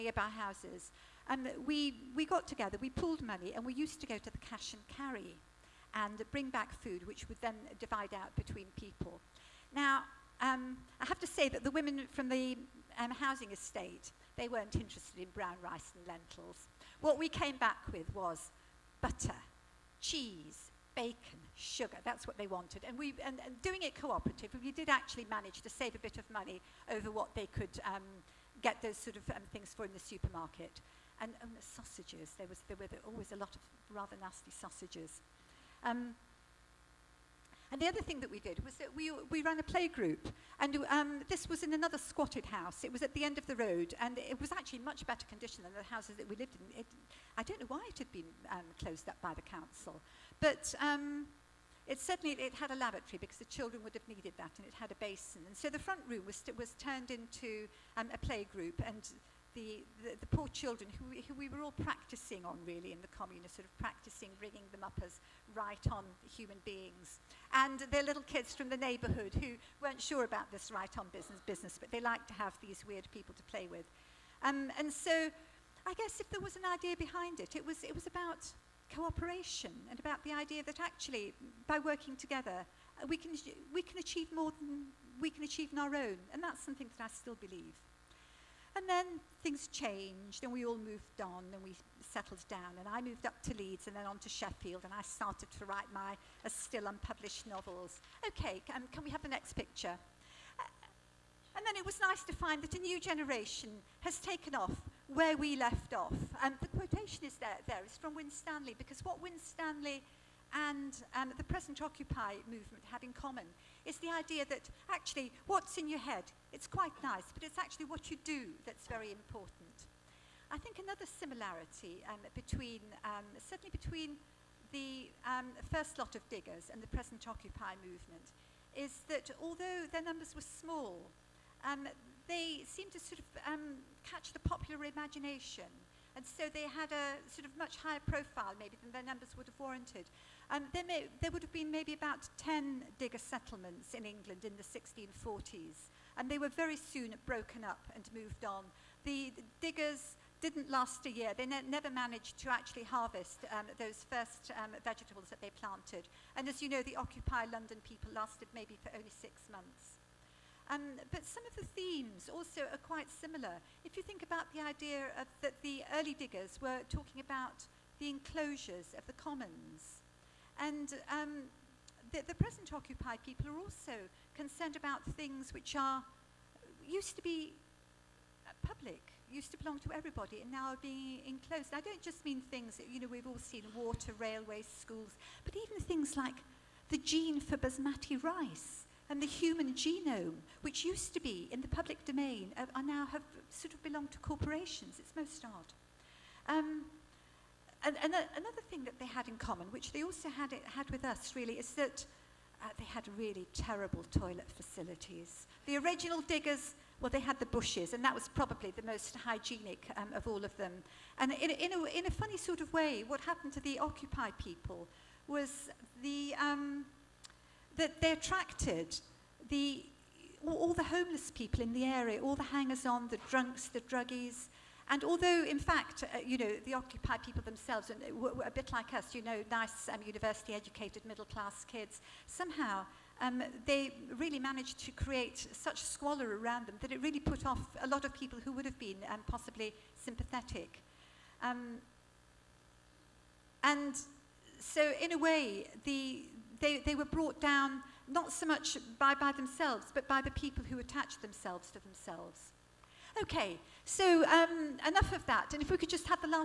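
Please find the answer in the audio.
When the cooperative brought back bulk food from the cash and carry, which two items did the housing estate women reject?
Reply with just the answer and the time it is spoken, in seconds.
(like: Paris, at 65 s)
brown rice and lentils, at 15 s.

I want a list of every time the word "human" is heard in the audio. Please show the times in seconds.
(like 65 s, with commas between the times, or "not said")
66 s, 189 s.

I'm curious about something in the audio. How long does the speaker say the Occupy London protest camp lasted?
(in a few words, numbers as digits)
six months.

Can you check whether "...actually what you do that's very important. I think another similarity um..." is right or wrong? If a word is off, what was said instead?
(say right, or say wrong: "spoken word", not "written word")
right.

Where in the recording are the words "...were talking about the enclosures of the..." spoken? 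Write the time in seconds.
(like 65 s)
166 s.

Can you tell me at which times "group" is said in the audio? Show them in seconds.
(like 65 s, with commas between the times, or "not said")
39 s, 58 s.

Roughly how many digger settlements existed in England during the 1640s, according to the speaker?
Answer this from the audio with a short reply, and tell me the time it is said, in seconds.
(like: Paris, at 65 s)
10, at 142 s.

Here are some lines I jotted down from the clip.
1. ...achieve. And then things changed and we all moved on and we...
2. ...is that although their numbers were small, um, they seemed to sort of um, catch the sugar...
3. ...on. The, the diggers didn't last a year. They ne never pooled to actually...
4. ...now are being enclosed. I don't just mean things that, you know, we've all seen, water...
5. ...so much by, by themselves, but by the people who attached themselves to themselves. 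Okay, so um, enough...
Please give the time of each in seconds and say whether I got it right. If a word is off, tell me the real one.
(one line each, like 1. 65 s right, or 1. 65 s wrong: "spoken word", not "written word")
1. 87 s wrong: "believe", not "achieve"
2. 128 s wrong: "popular", not "sugar"
3. 148 s wrong: "managed", not "pooled"
4. 180 s right
5. 248 s right.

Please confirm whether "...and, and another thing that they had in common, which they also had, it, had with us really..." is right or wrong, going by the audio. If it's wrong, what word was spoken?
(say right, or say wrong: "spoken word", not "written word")
right.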